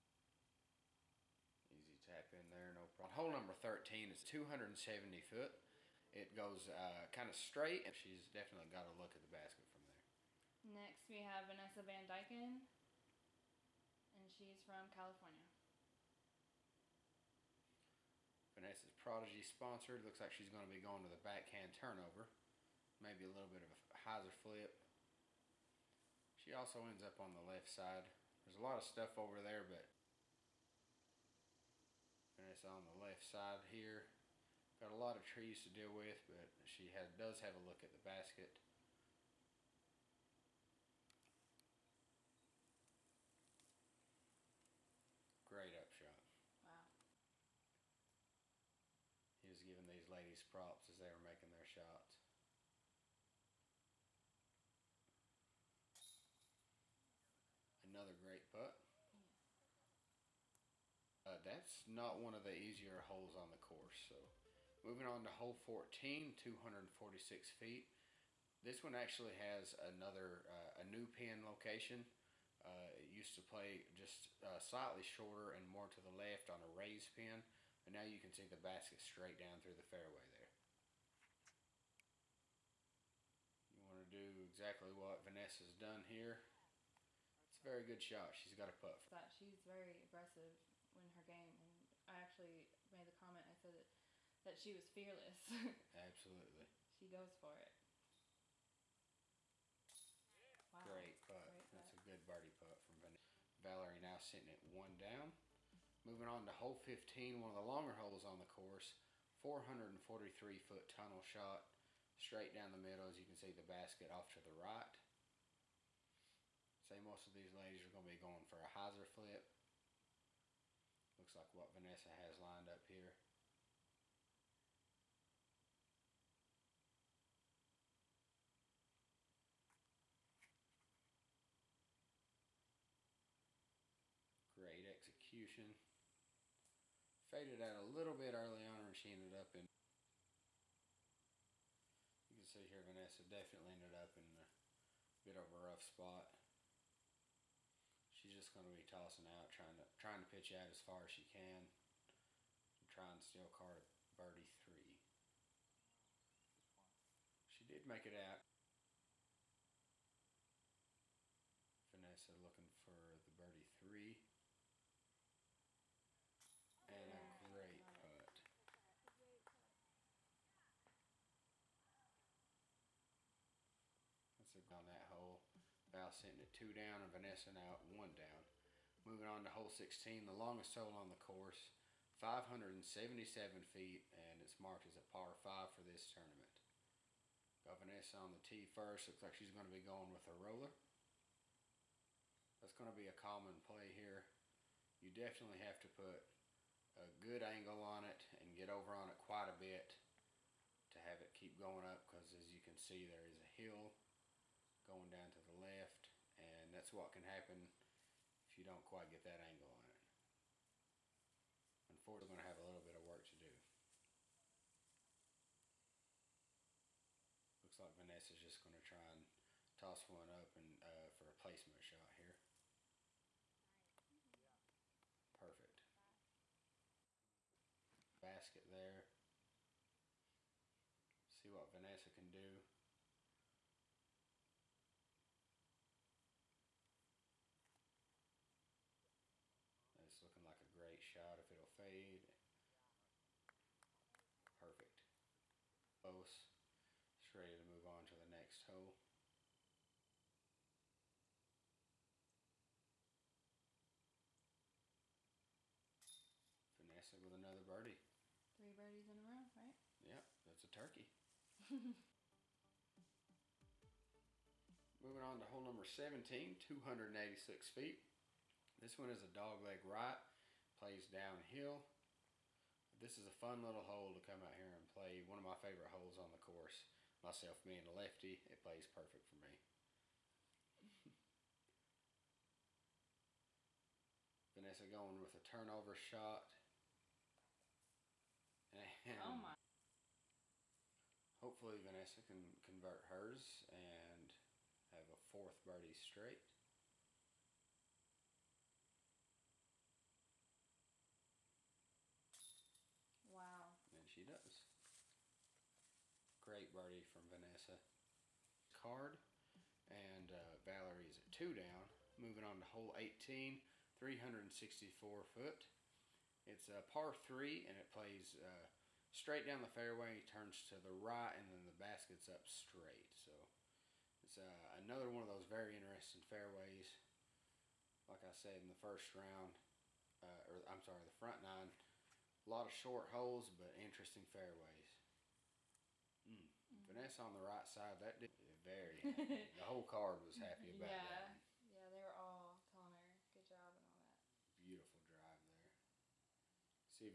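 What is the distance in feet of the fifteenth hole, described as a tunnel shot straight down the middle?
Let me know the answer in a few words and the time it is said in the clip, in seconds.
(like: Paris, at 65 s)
443, at 109 s.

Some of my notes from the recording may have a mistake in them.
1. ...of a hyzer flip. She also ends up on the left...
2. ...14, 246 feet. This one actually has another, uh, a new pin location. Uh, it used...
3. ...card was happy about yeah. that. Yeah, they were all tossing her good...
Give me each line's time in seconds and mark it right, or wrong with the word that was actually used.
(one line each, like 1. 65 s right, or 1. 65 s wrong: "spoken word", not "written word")
1. 23 s right
2. 65 s right
3. 339 s wrong: "telling", not "tossing".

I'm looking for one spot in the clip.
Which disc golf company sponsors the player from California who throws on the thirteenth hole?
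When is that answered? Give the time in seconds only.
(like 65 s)
18 s.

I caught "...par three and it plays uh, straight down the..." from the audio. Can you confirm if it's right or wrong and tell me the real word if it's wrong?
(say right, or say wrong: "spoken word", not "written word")
right.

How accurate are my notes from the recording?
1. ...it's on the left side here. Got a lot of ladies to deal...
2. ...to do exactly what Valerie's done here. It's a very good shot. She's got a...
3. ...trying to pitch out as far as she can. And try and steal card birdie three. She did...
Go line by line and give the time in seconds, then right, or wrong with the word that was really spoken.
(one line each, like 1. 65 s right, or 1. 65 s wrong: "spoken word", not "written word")
1. 32 s wrong: "trees", not "ladies"
2. 84 s wrong: "Vanessa", not "Valerie"
3. 149 s right.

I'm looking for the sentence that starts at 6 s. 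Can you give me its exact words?
It goes uh, kind of straight, and she's definitely got a look at the basket from there.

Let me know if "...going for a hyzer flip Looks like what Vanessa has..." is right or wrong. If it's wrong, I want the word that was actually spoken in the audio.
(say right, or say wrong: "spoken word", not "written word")
right.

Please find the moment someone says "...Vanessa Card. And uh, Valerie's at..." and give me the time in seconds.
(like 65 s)
307 s.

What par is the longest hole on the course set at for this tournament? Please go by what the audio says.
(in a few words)
par 5.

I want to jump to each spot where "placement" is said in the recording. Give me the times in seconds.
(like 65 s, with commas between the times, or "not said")
221 s.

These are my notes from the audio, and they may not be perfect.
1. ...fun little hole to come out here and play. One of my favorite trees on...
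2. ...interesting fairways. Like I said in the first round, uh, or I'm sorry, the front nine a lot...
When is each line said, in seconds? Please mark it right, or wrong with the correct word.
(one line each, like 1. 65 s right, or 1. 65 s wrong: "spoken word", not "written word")
1. 273 s wrong: "holes", not "trees"
2. 325 s right.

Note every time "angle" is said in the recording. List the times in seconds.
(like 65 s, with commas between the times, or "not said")
197 s, 209 s.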